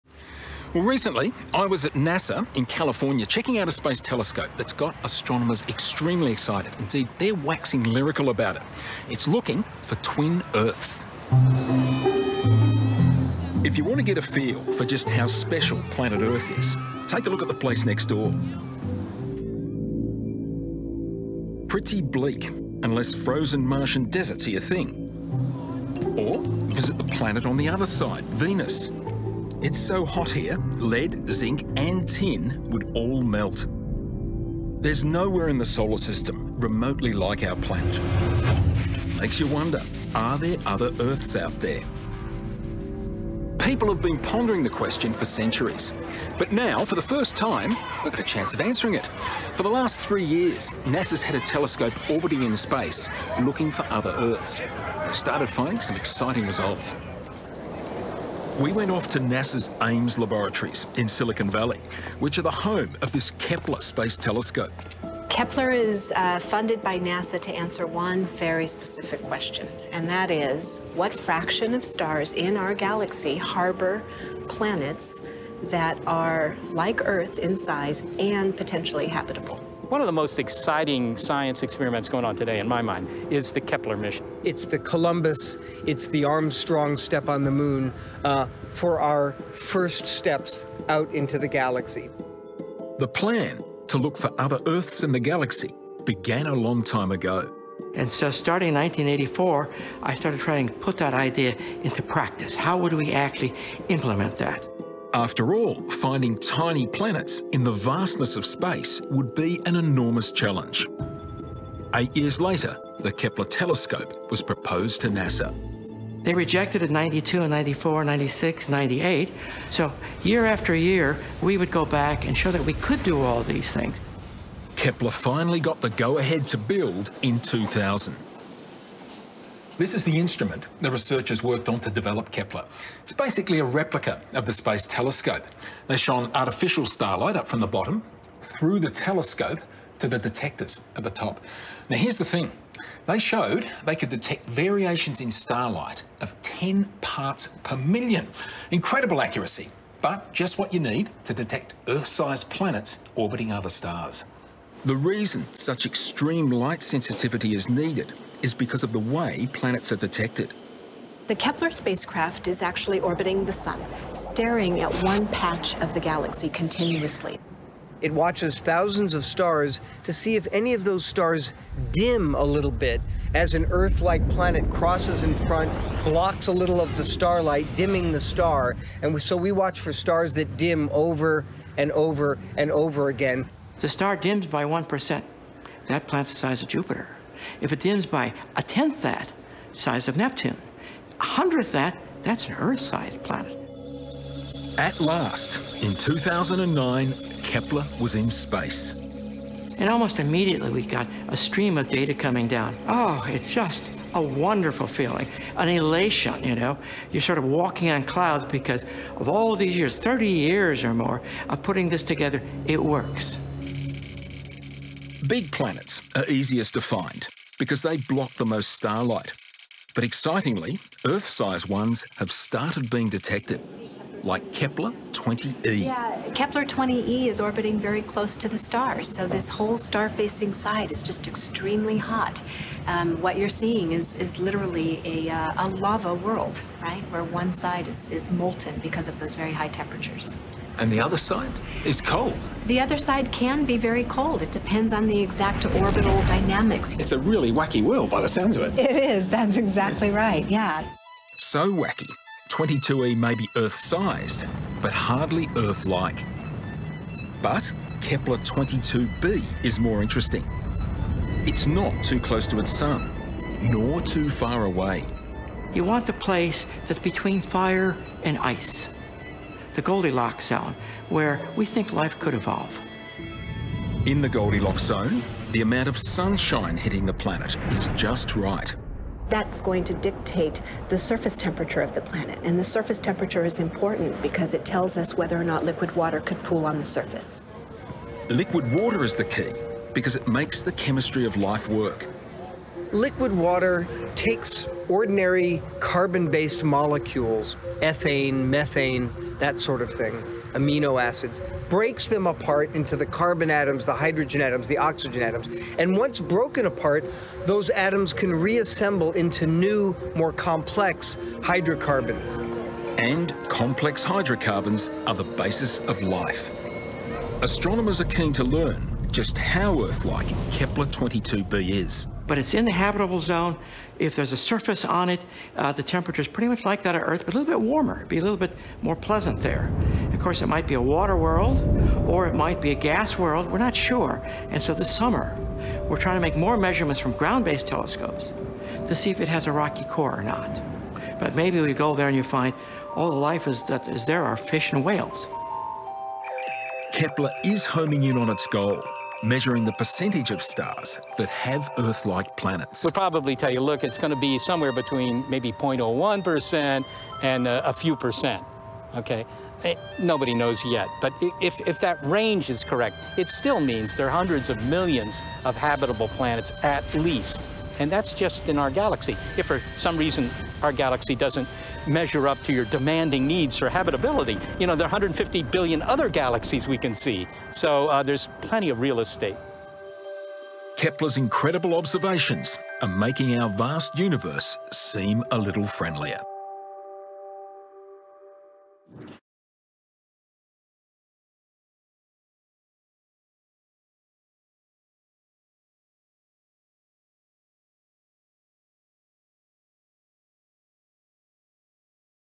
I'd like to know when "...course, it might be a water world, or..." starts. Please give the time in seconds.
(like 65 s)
330 s.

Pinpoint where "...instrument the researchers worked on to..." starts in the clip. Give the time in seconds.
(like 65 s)
130 s.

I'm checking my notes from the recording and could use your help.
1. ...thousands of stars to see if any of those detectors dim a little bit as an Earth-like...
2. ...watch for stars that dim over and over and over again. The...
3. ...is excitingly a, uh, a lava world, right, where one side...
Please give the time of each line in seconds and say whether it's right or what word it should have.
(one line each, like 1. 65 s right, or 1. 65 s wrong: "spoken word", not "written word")
1. 168 s wrong: "stars", not "detectors"
2. 179 s right
3. 234 s wrong: "literally", not "excitingly".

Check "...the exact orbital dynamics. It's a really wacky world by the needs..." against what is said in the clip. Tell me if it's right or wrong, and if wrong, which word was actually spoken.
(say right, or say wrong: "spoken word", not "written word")
wrong: "sounds", not "needs".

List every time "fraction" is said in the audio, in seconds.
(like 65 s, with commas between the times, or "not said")
71 s.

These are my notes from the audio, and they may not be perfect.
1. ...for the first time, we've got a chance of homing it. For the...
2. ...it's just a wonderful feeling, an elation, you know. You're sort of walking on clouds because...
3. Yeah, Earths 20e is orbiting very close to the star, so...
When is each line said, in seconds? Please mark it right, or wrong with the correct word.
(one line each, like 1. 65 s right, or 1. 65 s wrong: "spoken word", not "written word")
1. 46 s wrong: "answering", not "homing"
2. 203 s right
3. 225 s wrong: "Kepler", not "Earths".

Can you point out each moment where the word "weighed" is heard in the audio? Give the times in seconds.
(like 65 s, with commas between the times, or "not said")
not said.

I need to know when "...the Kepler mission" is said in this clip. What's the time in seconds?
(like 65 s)
83 s.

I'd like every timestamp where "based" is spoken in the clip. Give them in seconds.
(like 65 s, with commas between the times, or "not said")
295 s, 337 s.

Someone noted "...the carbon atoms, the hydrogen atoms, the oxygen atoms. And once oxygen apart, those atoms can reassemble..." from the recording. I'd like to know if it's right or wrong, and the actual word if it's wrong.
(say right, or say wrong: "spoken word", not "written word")
wrong: "broken", not "oxygen".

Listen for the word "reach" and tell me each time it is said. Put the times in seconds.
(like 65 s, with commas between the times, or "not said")
not said.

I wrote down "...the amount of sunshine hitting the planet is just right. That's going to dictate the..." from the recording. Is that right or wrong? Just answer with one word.
right.